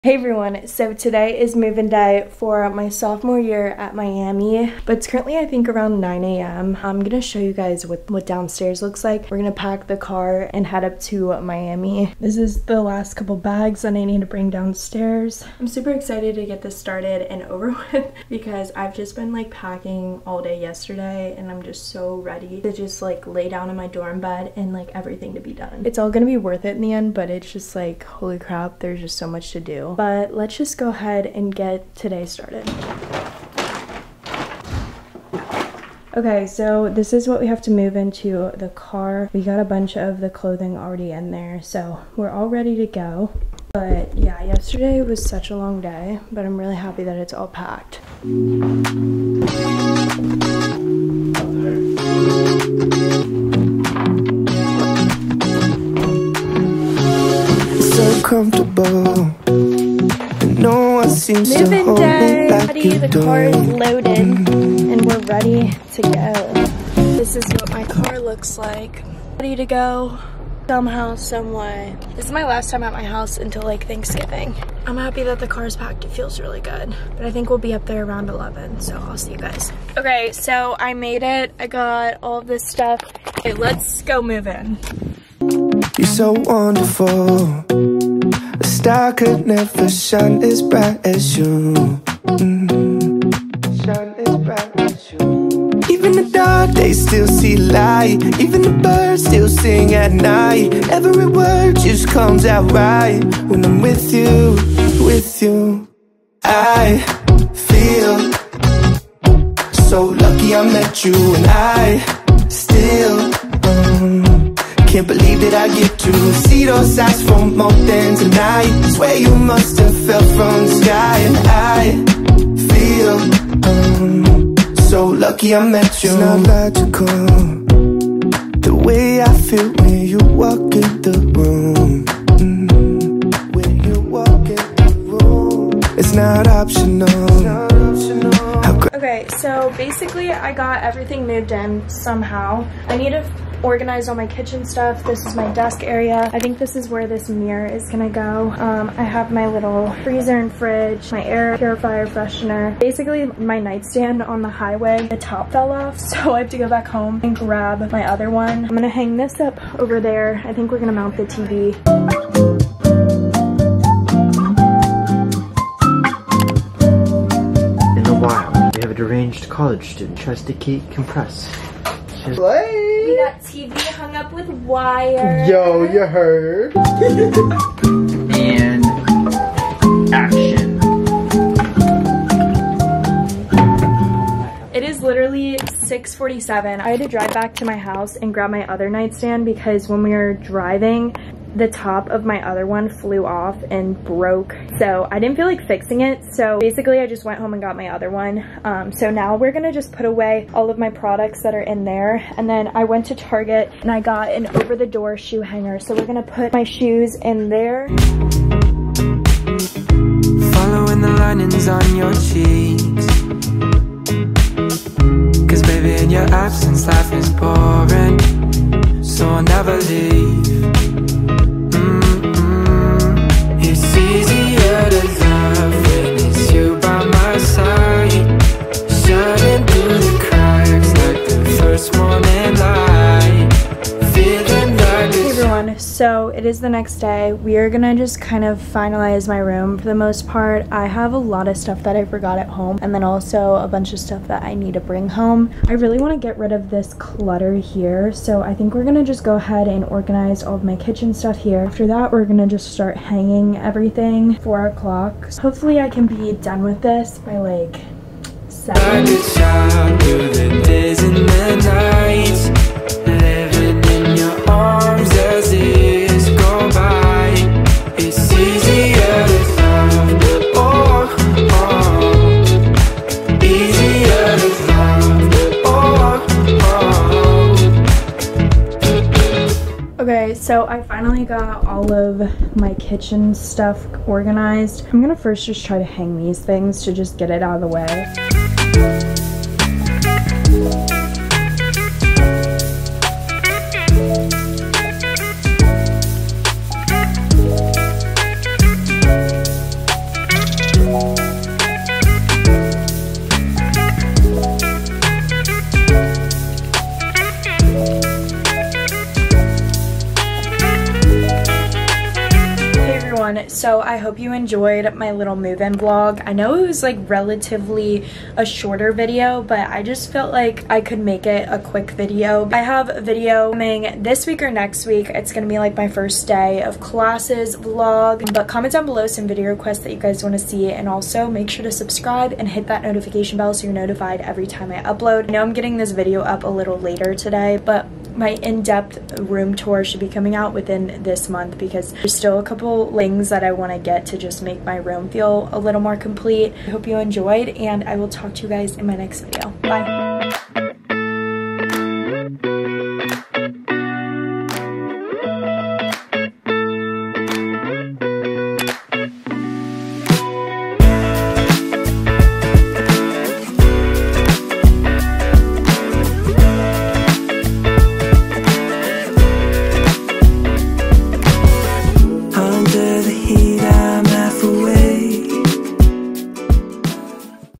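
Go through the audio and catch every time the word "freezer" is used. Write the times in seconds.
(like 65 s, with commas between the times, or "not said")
150 s.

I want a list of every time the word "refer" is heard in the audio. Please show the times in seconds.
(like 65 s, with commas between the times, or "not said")
not said.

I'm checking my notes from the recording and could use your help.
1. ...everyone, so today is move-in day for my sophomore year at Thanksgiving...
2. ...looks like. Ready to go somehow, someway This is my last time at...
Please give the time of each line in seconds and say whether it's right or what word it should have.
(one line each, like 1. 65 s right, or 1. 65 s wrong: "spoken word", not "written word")
1. 0 s wrong: "Miami", not "Thanksgiving"
2. 68 s right.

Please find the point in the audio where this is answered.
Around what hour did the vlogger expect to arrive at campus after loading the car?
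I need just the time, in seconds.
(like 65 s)
78 s.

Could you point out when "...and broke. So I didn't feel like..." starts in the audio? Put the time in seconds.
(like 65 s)
193 s.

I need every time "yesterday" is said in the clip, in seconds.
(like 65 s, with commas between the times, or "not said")
20 s, 44 s.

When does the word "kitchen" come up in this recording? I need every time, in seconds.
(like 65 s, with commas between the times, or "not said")
144 s, 250 s, 282 s.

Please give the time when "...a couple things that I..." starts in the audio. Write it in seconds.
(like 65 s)
342 s.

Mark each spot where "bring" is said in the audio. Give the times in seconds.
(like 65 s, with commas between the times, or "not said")
14 s, 244 s.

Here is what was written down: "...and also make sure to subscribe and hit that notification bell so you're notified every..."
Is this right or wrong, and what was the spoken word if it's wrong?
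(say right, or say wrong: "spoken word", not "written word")
right.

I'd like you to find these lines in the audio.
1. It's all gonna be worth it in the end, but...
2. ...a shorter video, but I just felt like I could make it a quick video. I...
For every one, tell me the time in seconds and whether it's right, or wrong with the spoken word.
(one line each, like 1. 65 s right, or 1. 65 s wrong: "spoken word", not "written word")
1. 25 s right
2. 318 s right.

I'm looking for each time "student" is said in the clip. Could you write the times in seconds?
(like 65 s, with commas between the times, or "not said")
169 s.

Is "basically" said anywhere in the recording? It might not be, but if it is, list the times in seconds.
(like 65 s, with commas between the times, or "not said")
139 s, 152 s, 196 s.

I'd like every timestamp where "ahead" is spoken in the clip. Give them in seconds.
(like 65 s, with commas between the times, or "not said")
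30 s, 249 s.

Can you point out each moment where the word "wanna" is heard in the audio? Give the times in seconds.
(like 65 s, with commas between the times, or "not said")
245 s, 330 s.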